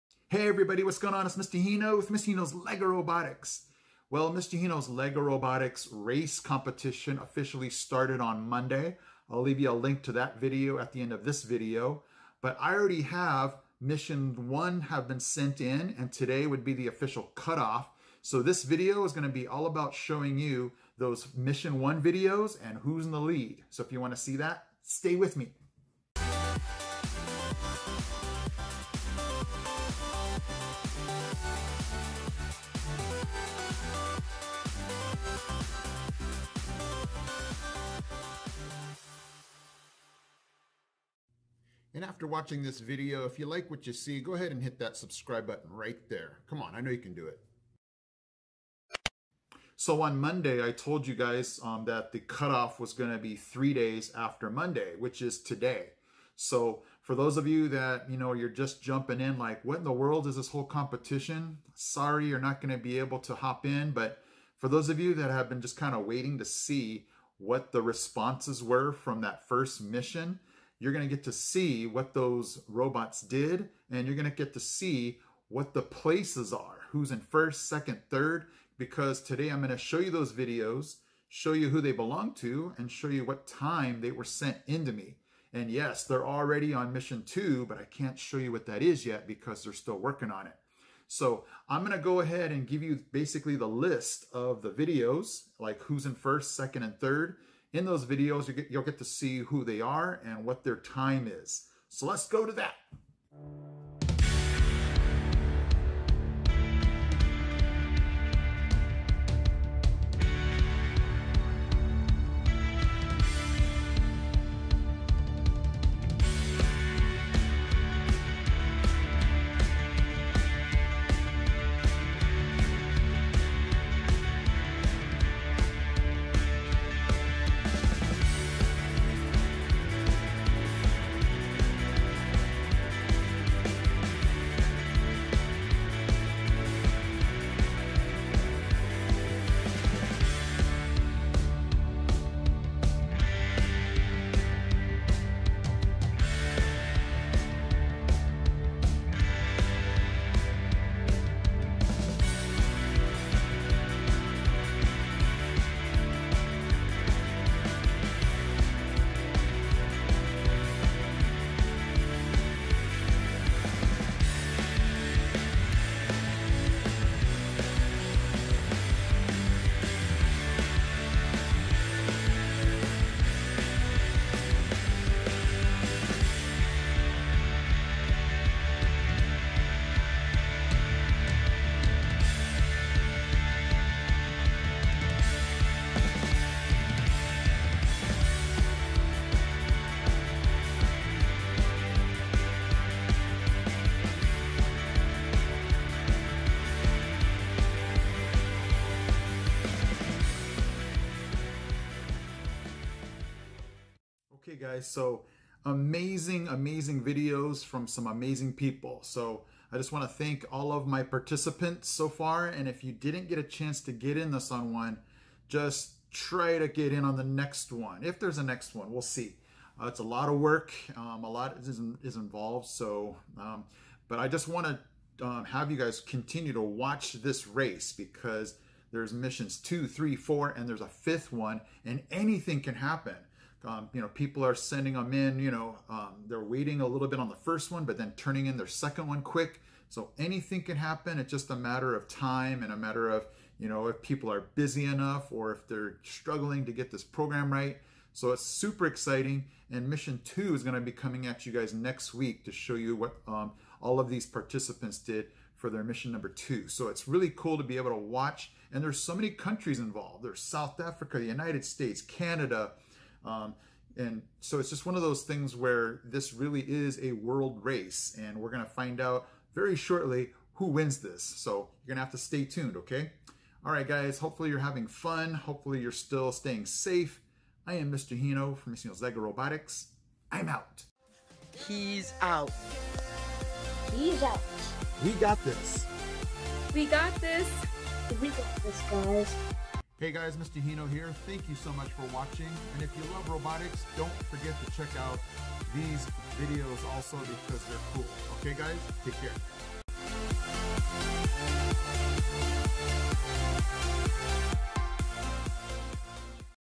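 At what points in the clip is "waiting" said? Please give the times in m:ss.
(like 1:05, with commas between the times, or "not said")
1:06, 3:56.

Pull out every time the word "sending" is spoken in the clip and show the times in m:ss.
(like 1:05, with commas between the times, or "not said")
3:54.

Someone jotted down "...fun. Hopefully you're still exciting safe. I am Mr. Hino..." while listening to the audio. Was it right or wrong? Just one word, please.
wrong.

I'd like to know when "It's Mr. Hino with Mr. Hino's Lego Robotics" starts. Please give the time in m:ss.
0:01.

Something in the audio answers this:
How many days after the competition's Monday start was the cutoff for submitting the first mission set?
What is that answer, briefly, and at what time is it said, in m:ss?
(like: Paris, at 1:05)
3, at 0:53.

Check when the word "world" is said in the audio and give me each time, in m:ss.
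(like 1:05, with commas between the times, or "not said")
0:59, 4:27.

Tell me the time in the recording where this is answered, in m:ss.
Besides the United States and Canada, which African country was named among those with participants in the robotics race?
4:20.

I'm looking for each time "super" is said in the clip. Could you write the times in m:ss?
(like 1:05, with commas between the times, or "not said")
4:08.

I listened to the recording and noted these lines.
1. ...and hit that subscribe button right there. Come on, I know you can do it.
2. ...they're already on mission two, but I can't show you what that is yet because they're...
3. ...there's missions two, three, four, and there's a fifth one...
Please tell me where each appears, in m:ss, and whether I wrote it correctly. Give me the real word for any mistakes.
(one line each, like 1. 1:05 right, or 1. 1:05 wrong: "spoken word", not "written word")
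1. 0:44 right
2. 1:26 right
3. 3:48 right.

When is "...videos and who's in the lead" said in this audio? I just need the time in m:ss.
0:22.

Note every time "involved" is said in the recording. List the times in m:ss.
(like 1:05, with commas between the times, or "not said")
3:42, 4:19.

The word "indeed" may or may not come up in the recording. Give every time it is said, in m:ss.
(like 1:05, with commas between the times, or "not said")
not said.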